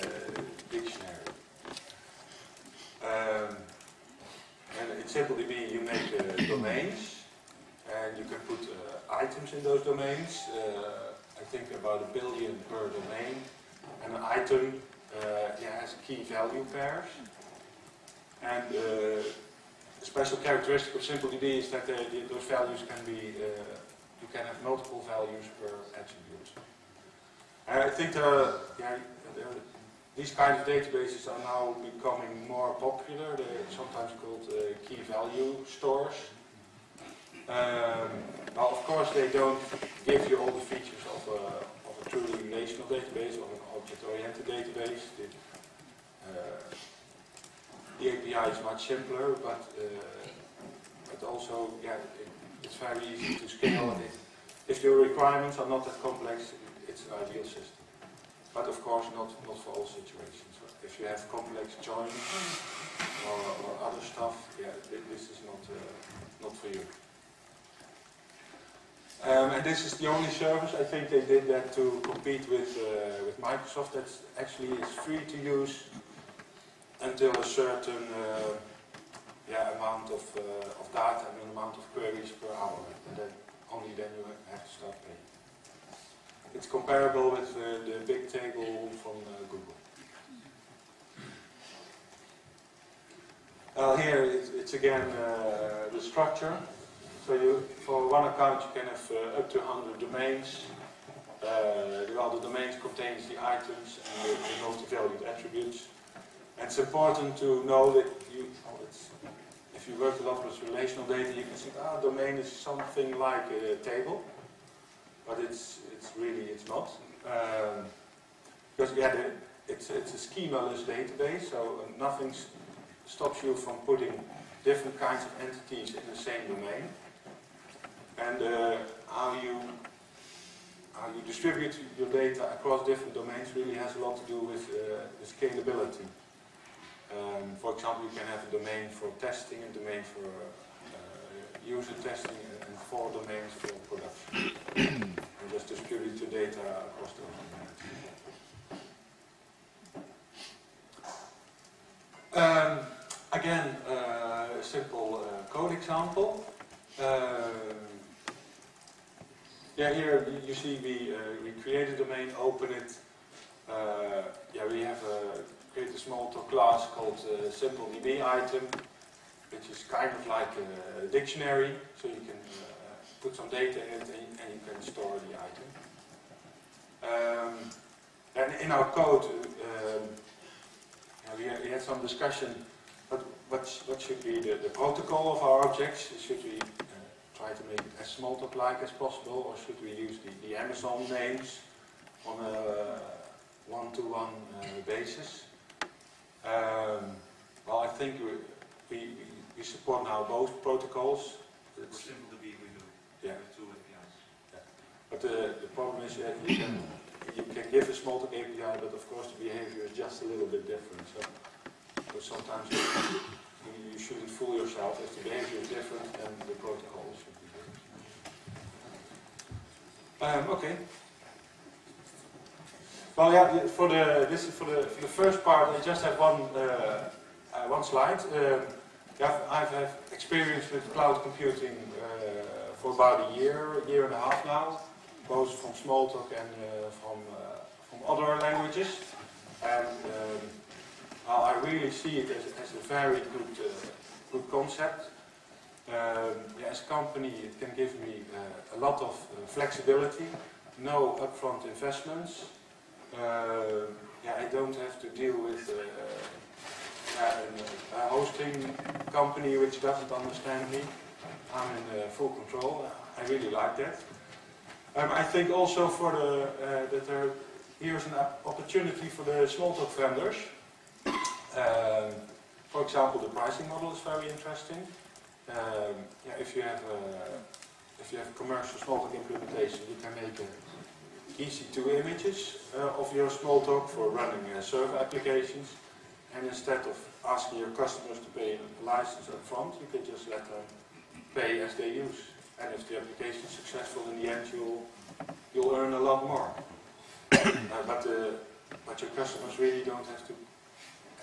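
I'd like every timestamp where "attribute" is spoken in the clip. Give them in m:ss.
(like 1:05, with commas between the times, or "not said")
0:26, 1:45.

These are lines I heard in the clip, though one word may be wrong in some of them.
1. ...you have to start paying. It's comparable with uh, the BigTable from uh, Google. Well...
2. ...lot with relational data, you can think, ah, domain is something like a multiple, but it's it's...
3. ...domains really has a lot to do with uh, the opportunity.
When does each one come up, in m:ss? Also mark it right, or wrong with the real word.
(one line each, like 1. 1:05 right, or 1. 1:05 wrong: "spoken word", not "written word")
1. 1:24 right
2. 1:50 wrong: "table", not "multiple"
3. 2:13 wrong: "scalability", not "opportunity".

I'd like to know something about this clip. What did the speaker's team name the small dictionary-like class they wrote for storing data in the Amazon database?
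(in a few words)
SimpleDB item.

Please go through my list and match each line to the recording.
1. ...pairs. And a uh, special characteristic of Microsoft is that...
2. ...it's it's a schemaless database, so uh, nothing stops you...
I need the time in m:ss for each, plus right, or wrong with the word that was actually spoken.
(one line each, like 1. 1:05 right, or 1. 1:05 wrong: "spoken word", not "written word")
1. 0:16 wrong: "SimpleDB", not "Microsoft"
2. 1:59 right.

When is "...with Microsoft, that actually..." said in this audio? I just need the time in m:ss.
1:13.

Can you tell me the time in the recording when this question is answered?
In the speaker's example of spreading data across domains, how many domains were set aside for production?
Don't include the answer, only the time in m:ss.
2:22.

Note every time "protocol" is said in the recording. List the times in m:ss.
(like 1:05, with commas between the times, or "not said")
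3:04, 3:20, 3:36.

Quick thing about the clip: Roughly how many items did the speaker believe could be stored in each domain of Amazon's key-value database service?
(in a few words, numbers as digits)
about a billion.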